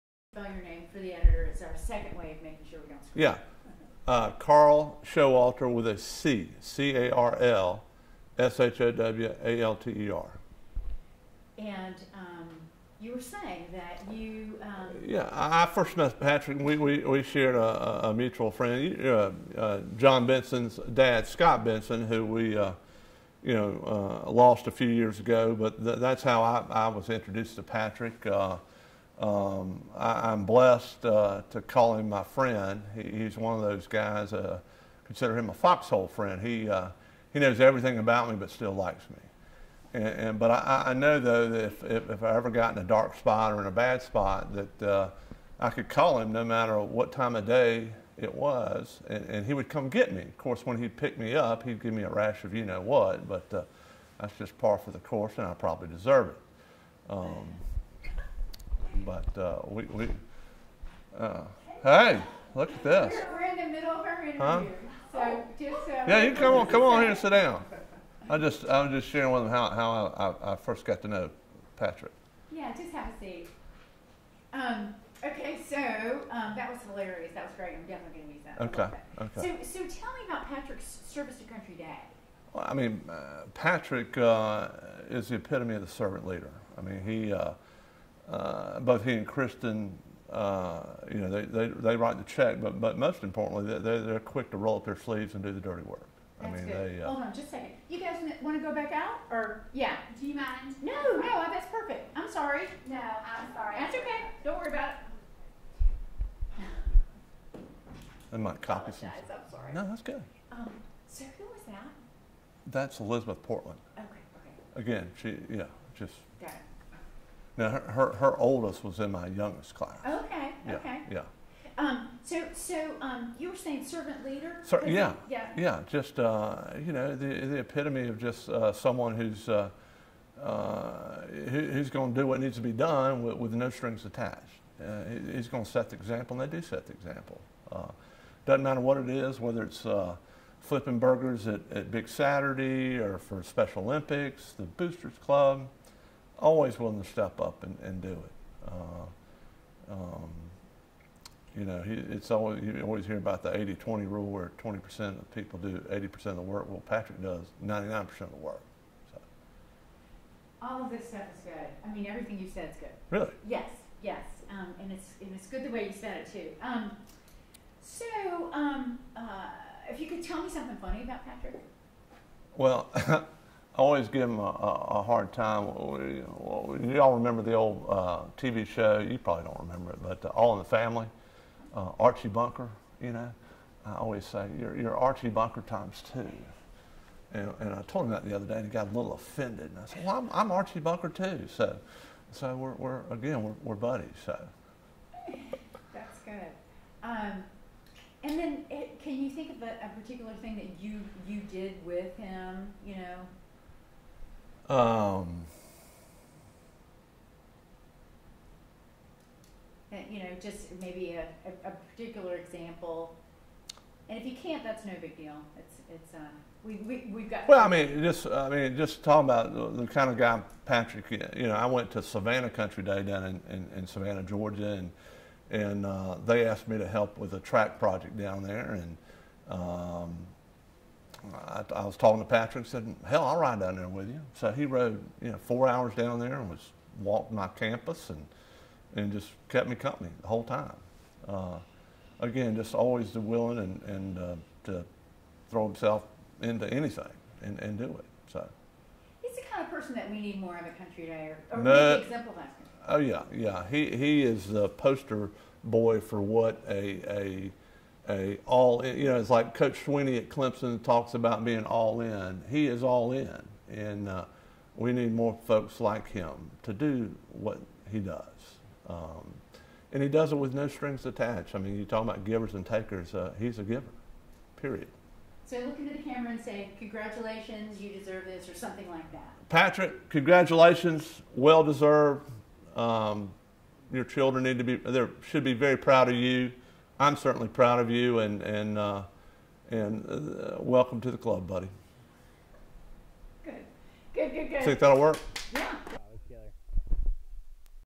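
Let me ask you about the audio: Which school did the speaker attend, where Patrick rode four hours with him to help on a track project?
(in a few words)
Savannah Country Day.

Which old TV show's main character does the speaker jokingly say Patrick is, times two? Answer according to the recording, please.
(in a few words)
All in the Family.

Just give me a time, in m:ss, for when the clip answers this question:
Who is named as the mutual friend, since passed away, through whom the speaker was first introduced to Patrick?
0:21.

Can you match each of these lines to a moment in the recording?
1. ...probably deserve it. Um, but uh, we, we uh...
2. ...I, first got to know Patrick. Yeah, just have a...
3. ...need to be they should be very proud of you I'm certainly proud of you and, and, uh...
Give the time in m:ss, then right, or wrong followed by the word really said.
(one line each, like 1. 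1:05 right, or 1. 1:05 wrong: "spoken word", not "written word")
1. 0:55 right
2. 1:10 right
3. 4:44 right.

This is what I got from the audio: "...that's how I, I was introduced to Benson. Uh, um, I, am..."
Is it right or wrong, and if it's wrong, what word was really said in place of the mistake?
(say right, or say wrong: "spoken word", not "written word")
wrong: "Patrick", not "Benson".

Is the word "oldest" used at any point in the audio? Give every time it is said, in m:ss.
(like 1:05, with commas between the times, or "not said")
1:58.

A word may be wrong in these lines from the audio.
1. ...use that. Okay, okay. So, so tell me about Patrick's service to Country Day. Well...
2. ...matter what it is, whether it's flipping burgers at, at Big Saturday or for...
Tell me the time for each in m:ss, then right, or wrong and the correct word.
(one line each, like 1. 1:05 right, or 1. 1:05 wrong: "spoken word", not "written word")
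1. 1:18 right
2. 2:18 right.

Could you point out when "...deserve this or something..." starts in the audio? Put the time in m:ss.
4:37.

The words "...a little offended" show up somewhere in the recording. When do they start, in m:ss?
3:08.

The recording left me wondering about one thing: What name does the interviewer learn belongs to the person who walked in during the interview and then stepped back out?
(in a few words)
Elizabeth Portland.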